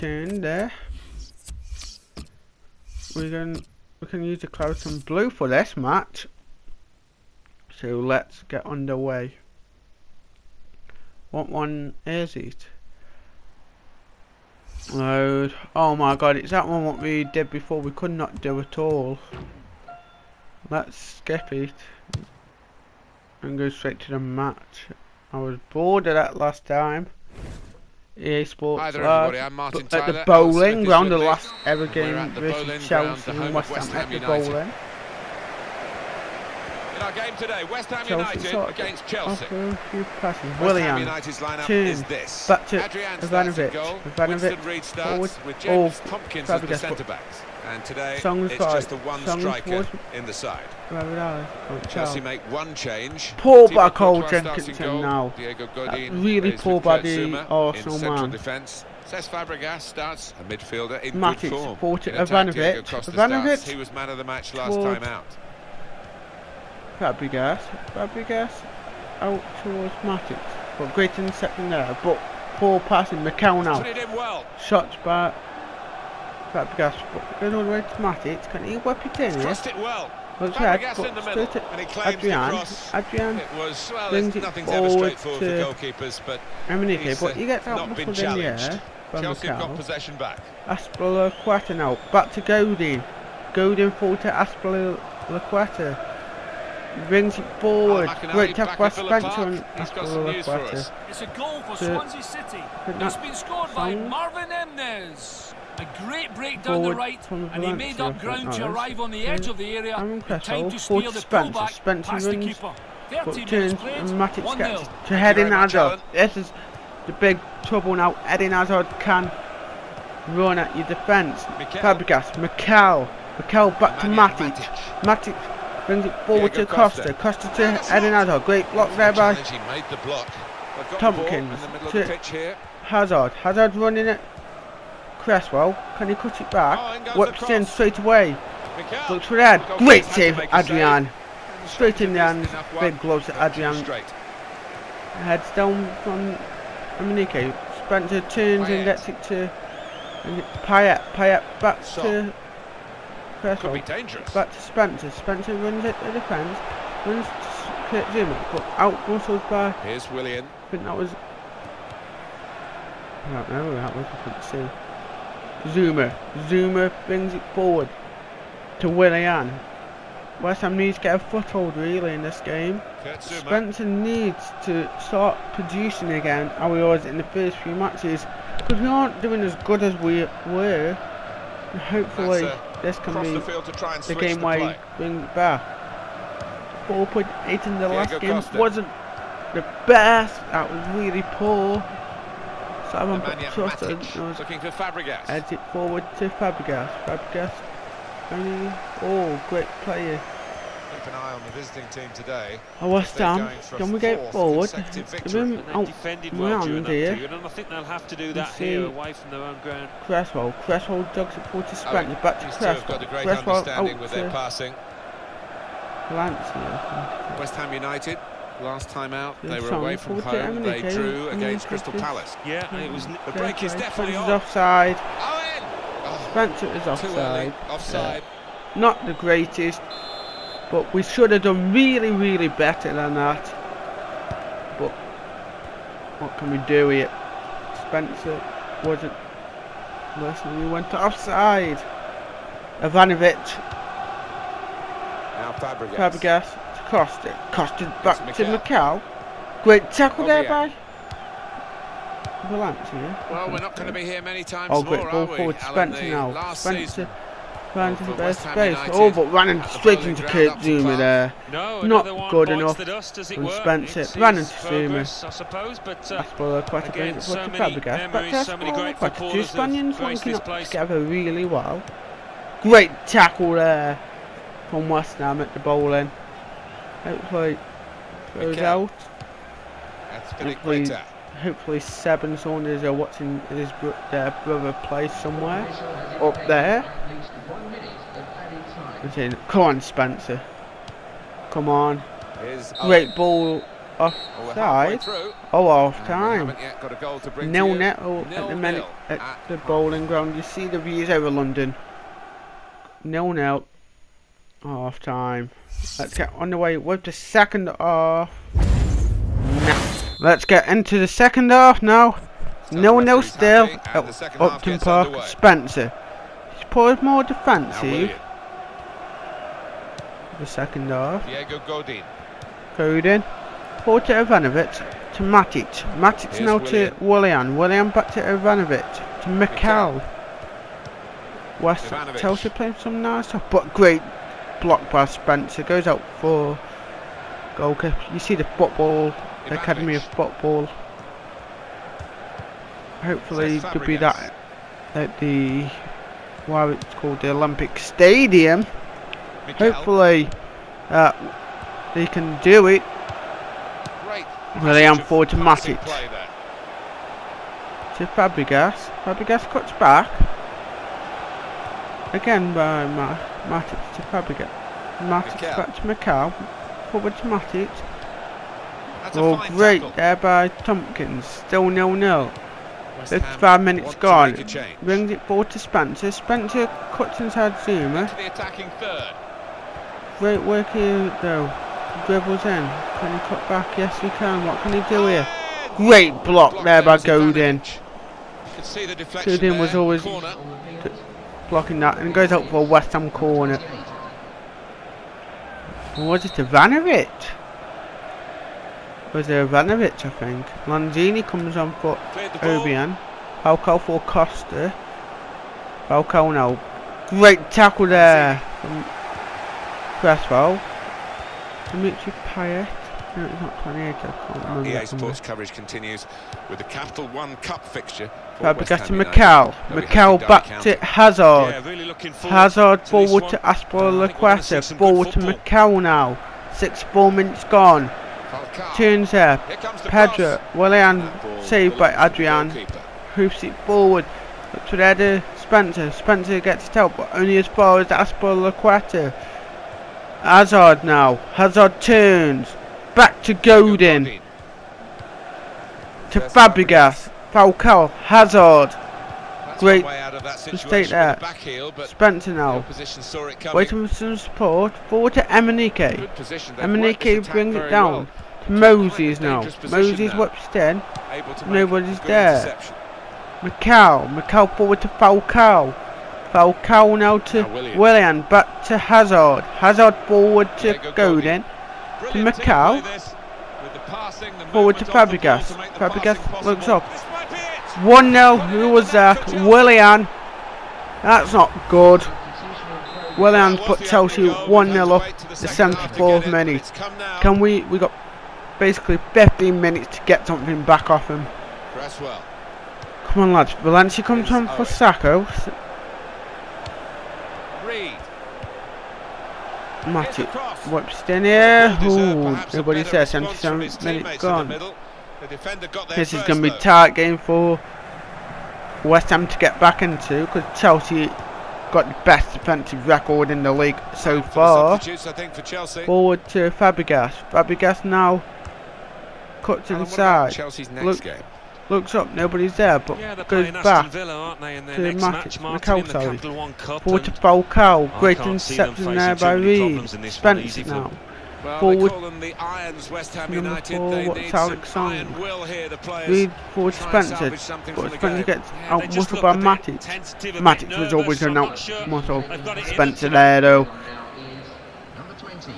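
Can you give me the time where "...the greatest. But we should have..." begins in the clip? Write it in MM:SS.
03:49.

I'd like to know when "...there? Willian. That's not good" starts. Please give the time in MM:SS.
07:58.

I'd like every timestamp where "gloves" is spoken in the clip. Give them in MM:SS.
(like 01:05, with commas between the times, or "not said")
02:23.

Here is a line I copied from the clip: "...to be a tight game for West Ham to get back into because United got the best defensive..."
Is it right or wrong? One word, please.
wrong.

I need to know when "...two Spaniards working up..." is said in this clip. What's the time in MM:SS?
04:29.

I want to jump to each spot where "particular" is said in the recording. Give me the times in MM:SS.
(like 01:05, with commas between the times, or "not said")
not said.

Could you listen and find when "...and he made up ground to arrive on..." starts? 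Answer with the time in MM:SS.
01:47.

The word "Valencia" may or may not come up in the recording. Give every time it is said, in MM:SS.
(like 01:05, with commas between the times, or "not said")
04:12, 08:13.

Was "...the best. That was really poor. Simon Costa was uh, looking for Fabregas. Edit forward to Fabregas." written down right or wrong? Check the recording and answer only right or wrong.
right.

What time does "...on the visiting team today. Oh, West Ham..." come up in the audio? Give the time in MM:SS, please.
03:21.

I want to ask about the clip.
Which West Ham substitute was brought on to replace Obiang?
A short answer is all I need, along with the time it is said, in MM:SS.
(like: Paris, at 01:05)
Lanzini, at 06:40.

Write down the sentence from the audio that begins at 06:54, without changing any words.
EA Sports coverage continues with the Capital One Cup fixture.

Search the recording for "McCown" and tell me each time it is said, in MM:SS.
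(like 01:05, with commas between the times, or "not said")
01:13.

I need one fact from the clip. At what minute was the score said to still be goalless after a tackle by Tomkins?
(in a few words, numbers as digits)
55.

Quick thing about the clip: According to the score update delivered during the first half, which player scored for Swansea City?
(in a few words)
Marvin Emnes.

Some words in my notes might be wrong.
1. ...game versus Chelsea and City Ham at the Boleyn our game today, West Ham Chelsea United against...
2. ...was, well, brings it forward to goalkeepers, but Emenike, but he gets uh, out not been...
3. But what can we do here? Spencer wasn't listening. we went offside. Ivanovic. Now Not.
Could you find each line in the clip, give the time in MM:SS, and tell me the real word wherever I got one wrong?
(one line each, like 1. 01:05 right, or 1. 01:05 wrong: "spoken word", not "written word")
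1. 00:31 wrong: "West", not "City"
2. 01:23 right
3. 03:54 wrong: "Fabregas", not "Not".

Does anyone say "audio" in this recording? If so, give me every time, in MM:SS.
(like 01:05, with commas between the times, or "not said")
not said.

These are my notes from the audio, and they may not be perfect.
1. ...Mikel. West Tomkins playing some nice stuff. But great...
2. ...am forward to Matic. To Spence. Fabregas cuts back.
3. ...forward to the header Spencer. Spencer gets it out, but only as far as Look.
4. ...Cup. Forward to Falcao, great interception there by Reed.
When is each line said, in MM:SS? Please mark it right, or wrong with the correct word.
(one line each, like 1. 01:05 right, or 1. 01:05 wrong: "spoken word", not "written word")
1. 05:29 wrong: "Chelsea", not "Tomkins"
2. 05:54 wrong: "Fabregas", not "Spence"
3. 07:13 wrong: "Azpilicueta", not "Look"
4. 08:46 right.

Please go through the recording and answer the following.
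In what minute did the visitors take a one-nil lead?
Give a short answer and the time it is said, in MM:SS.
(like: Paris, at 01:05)
74th, at 08:05.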